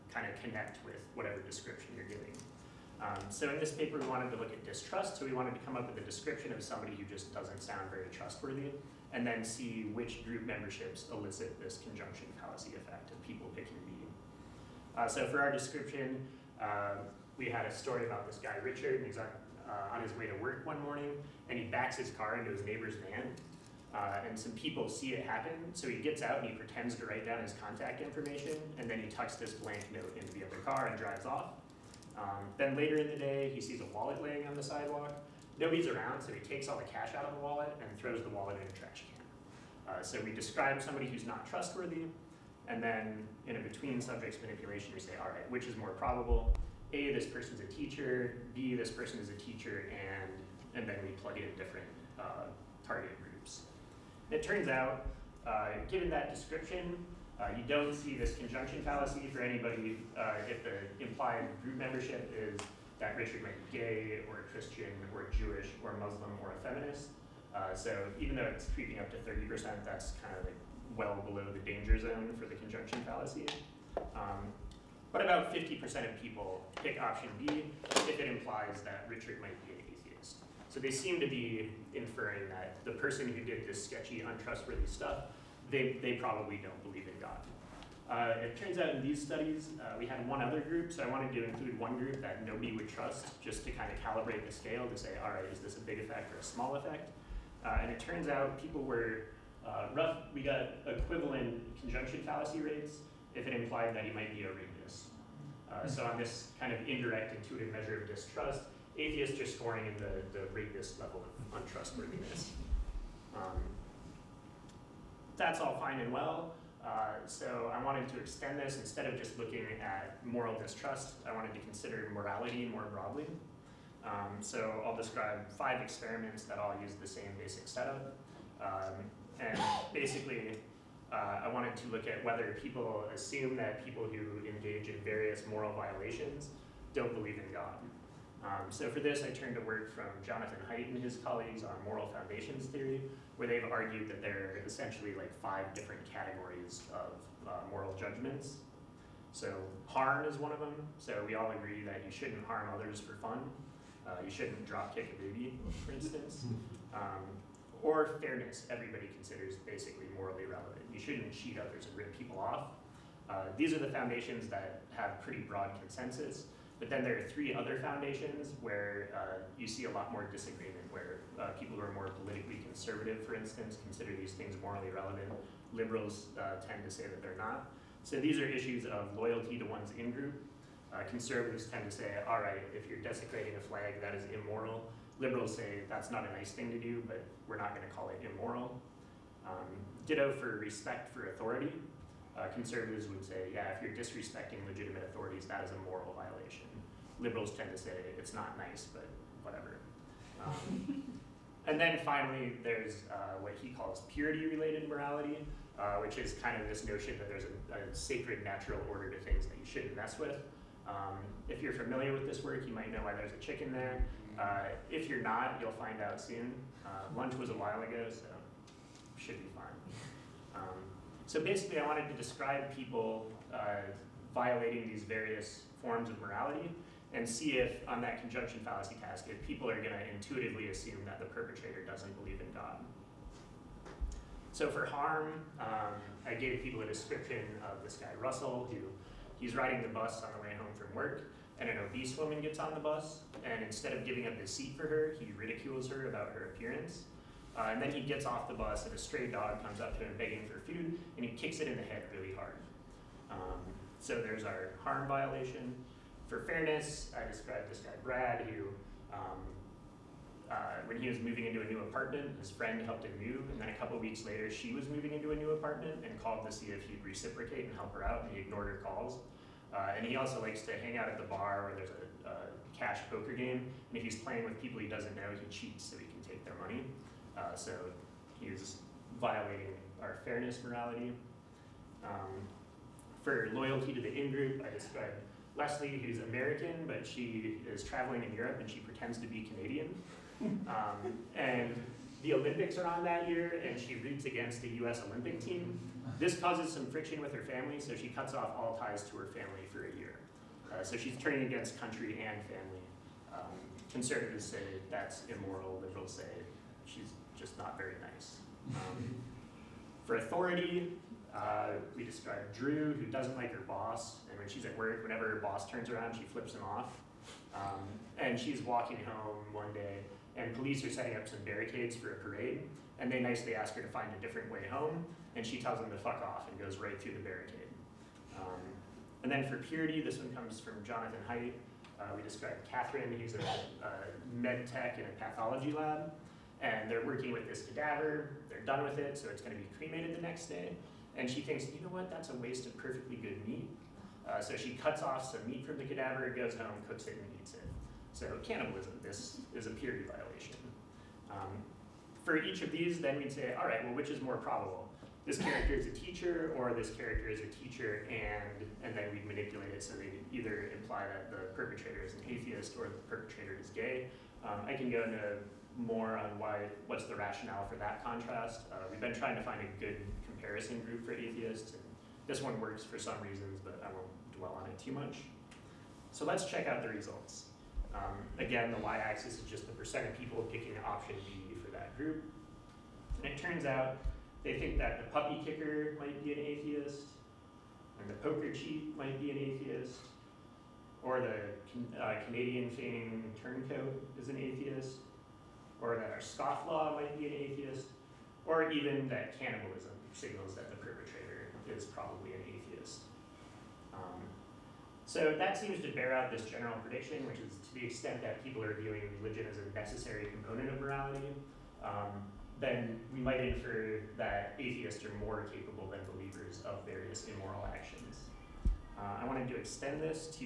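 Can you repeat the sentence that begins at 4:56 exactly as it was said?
This causes some friction with her family, so she cuts off all ties to her family for a year.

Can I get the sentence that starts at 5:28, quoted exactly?
Um, and then for purity, this one comes from Jonathan Haidt.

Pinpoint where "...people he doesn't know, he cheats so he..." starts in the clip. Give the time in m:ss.
4:34.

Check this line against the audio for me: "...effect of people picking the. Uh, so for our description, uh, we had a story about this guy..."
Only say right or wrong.
right.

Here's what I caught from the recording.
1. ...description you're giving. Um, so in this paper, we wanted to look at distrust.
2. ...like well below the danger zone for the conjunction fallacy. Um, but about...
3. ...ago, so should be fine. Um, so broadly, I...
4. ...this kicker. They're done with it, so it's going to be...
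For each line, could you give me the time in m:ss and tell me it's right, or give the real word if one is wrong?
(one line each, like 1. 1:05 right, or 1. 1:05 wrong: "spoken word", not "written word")
1. 0:01 right
2. 1:10 right
3. 3:37 wrong: "basically", not "broadly"
4. 5:37 wrong: "cadaver", not "kicker".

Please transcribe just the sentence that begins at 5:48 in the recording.
So cannibalism, this is a purity violation.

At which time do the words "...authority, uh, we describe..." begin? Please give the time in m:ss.
5:10.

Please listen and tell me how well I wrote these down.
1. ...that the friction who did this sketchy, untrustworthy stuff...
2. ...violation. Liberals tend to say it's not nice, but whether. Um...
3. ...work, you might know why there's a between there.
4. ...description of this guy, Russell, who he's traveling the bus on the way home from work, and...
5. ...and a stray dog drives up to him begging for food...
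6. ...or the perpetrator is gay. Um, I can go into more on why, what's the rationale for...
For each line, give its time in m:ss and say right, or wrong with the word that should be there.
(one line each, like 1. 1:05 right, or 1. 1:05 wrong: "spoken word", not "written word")
1. 1:22 wrong: "person", not "friction"
2. 3:16 wrong: "whatever", not "whether"
3. 3:32 wrong: "chicken", not "between"
4. 3:56 wrong: "riding", not "traveling"
5. 4:08 wrong: "comes", not "drives"
6. 6:02 right.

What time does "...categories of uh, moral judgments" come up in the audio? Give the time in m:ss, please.
2:26.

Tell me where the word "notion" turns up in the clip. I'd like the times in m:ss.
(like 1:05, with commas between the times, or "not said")
3:26.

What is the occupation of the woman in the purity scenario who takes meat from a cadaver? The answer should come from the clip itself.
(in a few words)
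Med tech.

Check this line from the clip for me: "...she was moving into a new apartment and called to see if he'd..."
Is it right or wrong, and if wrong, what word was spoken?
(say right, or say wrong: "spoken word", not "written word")
right.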